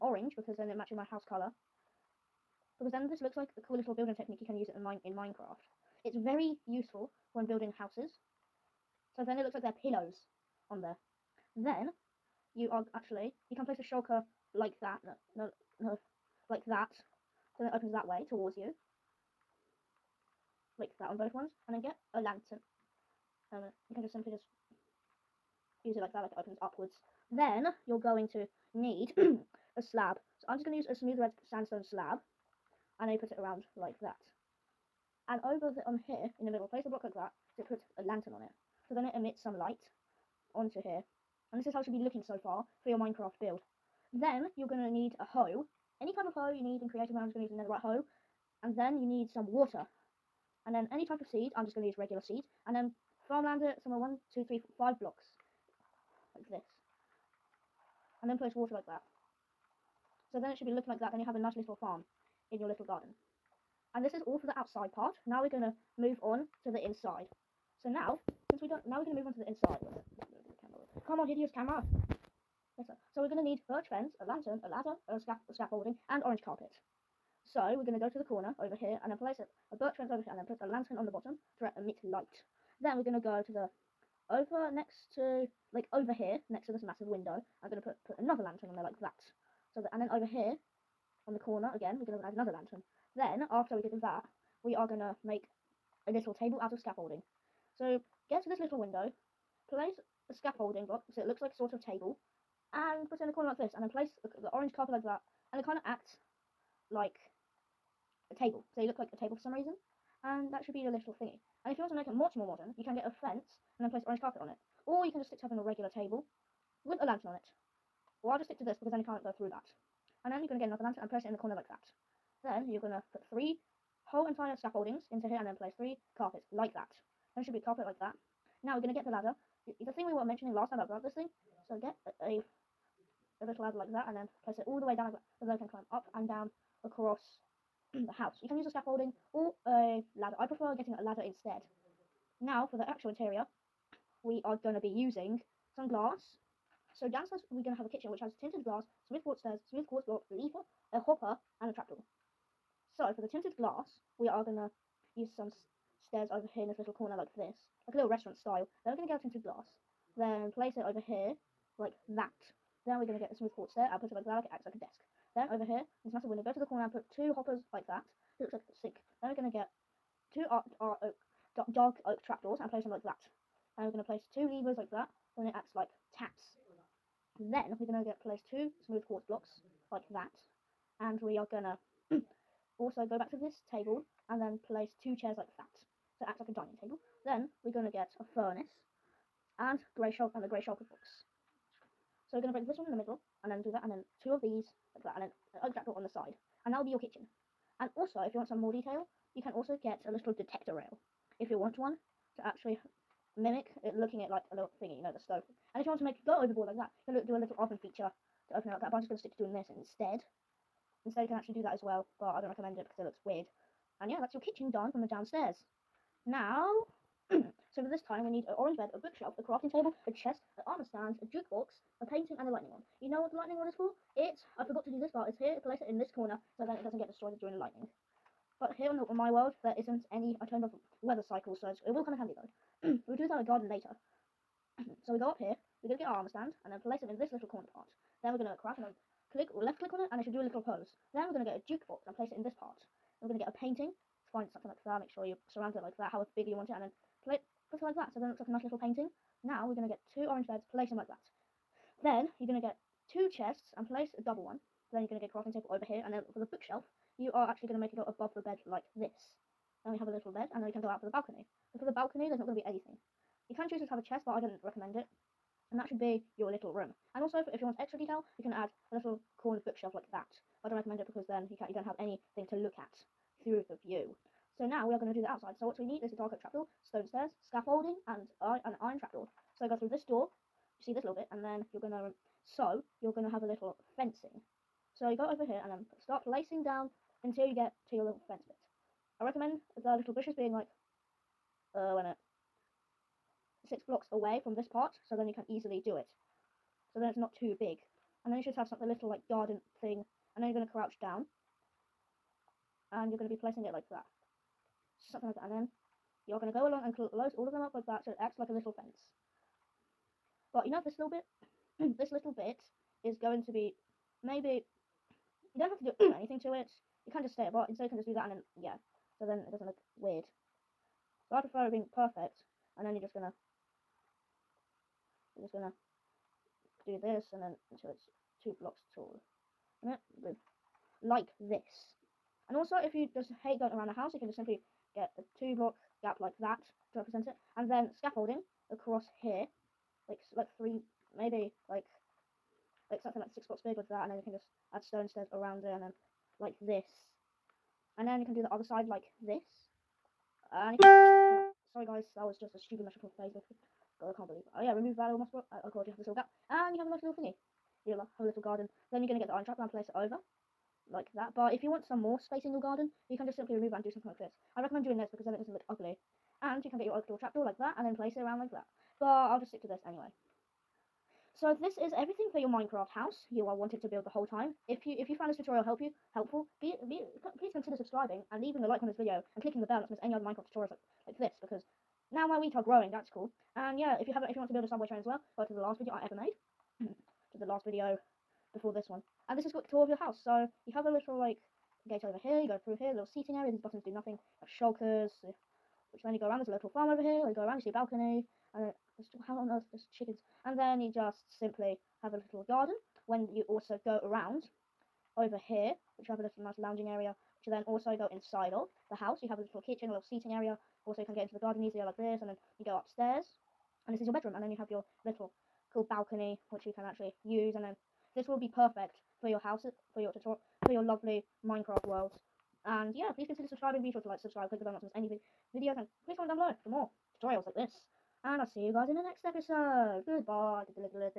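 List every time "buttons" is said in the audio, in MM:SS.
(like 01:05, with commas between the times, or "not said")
06:33.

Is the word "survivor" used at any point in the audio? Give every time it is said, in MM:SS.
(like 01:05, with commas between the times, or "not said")
not said.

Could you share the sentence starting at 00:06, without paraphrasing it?
It's very useful when building houses.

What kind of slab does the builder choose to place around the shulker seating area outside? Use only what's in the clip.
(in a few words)
Smooth red sandstone slab.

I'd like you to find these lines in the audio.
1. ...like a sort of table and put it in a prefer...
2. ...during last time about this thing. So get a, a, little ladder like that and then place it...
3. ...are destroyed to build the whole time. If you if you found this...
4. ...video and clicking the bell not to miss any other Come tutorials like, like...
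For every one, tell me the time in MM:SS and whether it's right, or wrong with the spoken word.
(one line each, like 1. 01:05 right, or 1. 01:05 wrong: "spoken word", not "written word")
1. 01:41 wrong: "corner", not "prefer"
2. 02:10 wrong: "mentioning", not "during"
3. 06:13 wrong: "wanted", not "destroyed"
4. 06:18 wrong: "Minecraft", not "Come".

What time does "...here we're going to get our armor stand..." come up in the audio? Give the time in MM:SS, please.
03:55.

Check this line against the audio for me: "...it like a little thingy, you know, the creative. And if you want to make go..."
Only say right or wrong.
wrong.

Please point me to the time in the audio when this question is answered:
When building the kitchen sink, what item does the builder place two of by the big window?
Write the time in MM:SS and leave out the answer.
02:47.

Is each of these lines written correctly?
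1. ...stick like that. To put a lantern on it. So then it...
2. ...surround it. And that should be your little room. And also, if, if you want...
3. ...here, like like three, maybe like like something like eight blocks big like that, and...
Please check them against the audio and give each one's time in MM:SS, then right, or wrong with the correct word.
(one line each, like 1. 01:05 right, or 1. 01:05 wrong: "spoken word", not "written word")
1. 00:36 wrong: "block", not "stick"
2. 04:24 wrong: "recommend", not "surround"
3. 05:39 wrong: "six", not "eight".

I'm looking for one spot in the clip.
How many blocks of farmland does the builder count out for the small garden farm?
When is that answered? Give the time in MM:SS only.
00:54.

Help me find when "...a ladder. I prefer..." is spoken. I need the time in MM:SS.
02:19.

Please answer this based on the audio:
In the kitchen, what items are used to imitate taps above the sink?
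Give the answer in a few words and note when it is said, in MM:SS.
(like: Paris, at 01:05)
Levers, at 02:54.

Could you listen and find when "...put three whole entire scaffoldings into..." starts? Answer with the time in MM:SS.
02:03.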